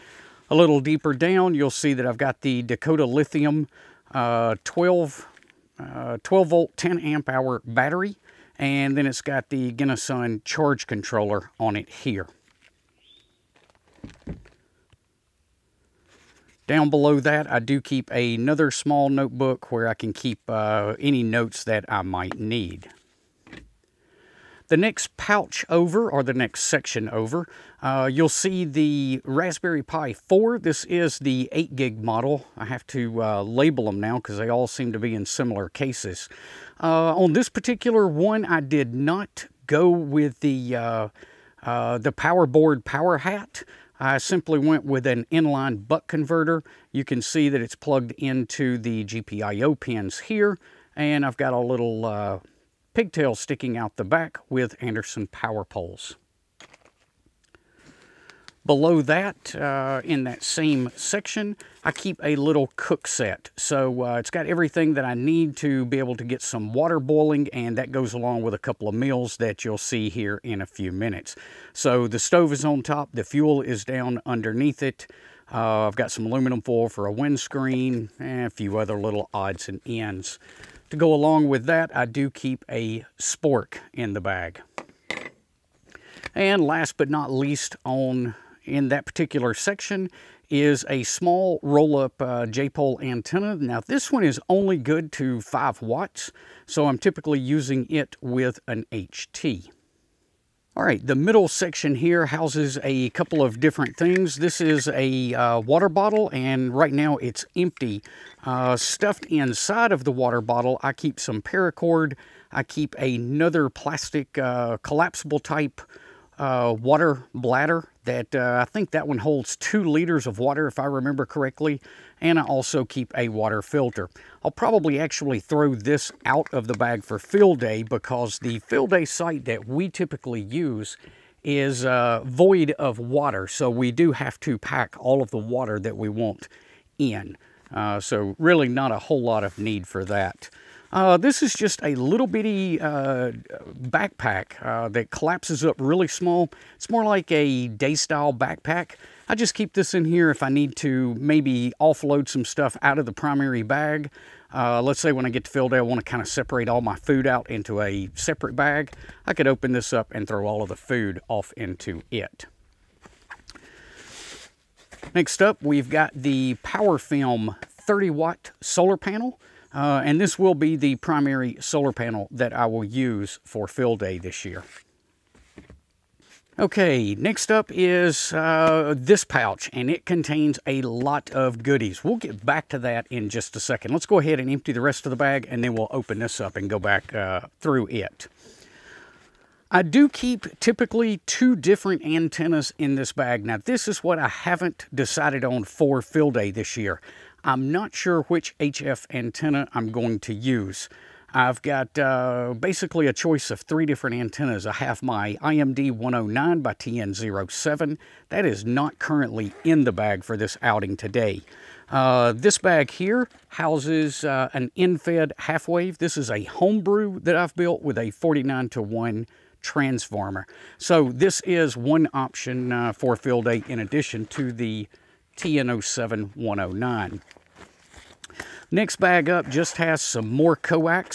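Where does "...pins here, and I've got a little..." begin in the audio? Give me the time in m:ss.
0:49.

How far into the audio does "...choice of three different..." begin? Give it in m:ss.
3:23.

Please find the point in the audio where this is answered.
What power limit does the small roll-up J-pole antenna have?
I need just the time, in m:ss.
1:35.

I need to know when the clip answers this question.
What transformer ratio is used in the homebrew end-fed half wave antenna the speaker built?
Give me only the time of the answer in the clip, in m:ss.
3:38.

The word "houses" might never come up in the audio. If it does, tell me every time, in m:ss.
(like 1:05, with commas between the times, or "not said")
1:42, 3:33.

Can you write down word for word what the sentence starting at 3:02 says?
We'll get back to that in just a second.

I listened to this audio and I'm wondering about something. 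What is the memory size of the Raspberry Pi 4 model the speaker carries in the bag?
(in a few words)
8 gig.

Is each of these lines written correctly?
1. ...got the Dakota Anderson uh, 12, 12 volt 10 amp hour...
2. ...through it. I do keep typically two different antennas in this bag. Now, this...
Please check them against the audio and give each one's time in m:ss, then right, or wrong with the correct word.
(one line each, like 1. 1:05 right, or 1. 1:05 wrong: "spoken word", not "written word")
1. 0:02 wrong: "Lithium", not "Anderson"
2. 3:07 right.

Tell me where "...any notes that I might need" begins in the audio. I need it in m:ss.
0:20.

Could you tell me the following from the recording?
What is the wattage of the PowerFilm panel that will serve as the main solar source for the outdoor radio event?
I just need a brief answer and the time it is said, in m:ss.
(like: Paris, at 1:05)
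30 watt, at 2:47.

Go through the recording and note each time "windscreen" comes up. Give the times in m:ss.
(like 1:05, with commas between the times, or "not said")
1:17.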